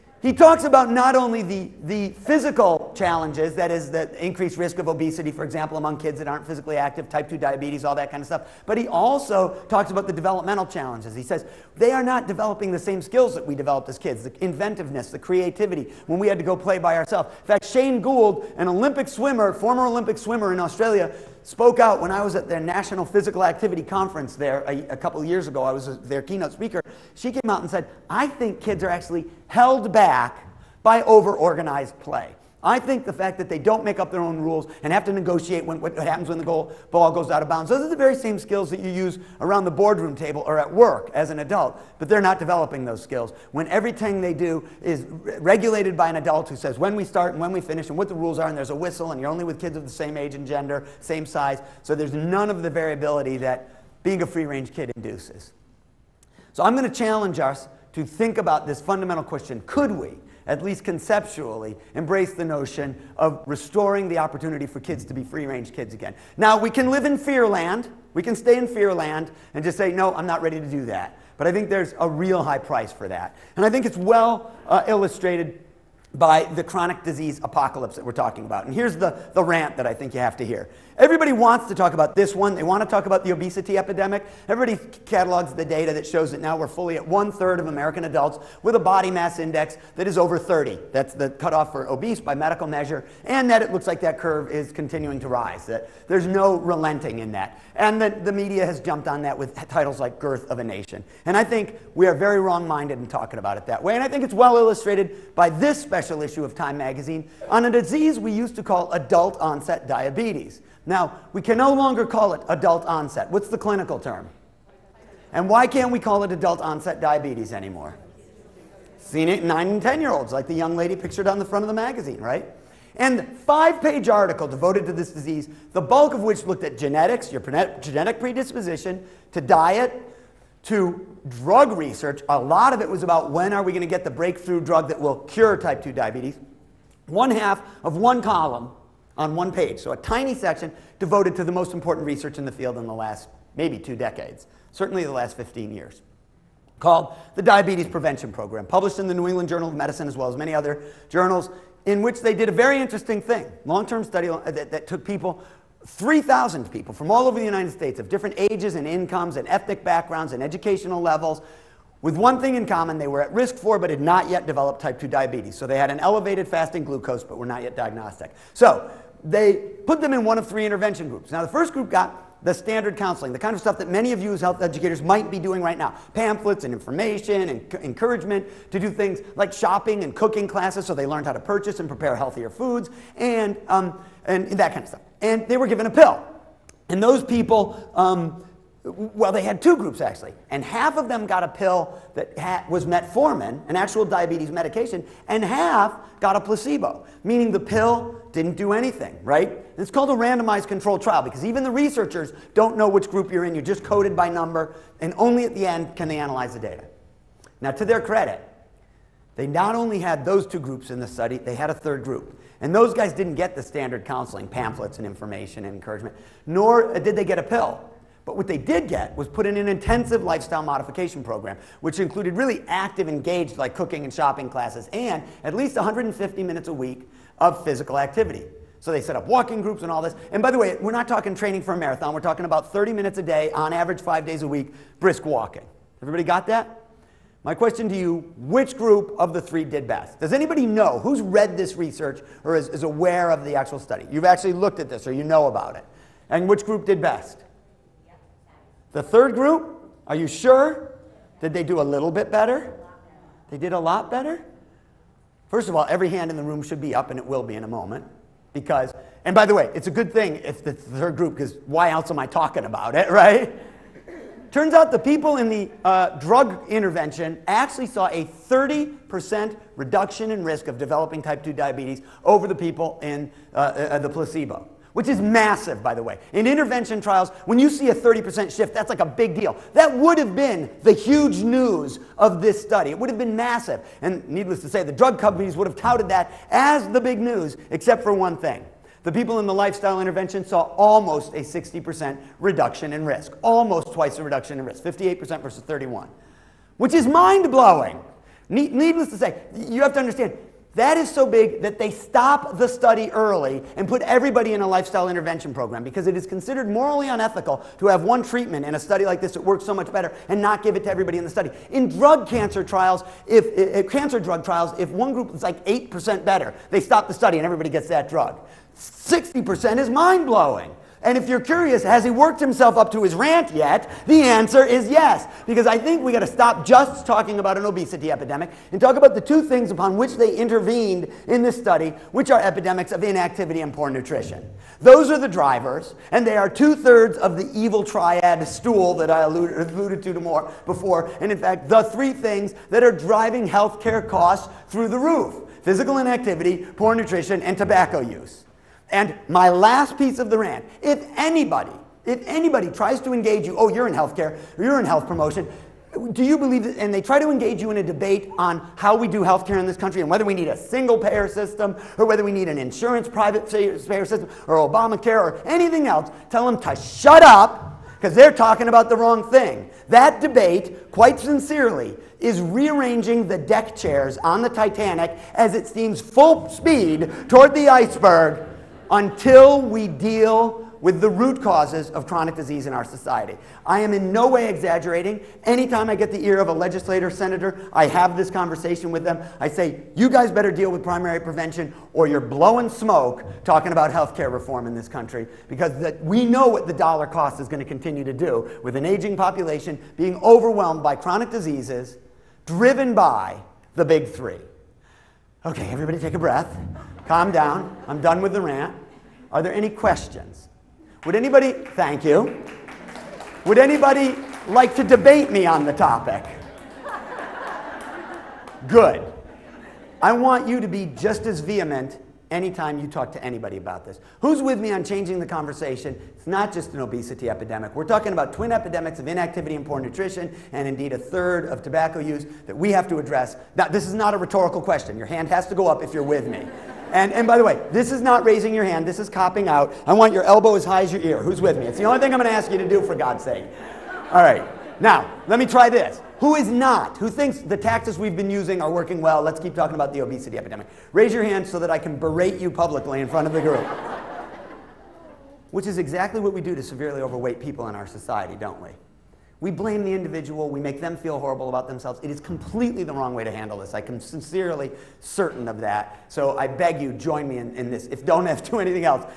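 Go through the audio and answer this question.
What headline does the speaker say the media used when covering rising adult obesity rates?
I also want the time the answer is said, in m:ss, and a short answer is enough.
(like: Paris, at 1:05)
Girth of a Nation, at 1:40.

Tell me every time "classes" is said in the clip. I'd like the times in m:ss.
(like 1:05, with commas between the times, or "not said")
3:00, 3:44.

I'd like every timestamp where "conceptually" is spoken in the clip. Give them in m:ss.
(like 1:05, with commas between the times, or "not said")
1:00.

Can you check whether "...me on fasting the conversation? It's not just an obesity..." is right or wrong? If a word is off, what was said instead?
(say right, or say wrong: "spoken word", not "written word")
wrong: "changing", not "fasting".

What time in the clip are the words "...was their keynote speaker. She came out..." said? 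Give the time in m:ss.
0:25.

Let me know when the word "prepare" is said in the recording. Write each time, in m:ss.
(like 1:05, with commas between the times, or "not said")
3:01.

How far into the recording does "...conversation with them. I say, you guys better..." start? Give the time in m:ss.
6:28.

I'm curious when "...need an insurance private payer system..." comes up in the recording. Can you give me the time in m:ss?
6:02.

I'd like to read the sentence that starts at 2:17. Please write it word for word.
One half of one column on one page.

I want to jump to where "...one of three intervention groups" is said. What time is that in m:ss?
2:50.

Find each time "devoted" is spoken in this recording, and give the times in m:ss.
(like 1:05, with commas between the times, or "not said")
2:04, 2:20.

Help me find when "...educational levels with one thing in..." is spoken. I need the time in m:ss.
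2:40.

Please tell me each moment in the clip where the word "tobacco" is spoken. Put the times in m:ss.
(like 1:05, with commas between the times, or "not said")
5:47, 7:11.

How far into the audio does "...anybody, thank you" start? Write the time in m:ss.
6:51.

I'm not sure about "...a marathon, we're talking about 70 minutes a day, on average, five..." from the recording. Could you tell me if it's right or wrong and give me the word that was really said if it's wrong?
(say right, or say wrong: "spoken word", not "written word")
wrong: "30", not "70".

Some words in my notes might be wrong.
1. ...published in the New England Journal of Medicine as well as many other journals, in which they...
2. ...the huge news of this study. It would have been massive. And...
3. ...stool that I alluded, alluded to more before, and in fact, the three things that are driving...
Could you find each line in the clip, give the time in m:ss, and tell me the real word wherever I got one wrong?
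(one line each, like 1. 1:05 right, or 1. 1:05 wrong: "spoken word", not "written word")
1. 2:28 right
2. 4:40 right
3. 5:38 right.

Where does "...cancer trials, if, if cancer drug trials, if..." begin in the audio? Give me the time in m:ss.
5:12.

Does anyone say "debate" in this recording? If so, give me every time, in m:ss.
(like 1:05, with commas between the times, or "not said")
5:57, 6:10, 6:54.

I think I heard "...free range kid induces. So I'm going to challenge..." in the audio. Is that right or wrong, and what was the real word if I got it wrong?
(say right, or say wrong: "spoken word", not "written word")
right.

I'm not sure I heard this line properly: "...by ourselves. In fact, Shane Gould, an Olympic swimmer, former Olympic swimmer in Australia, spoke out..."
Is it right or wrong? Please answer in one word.
right.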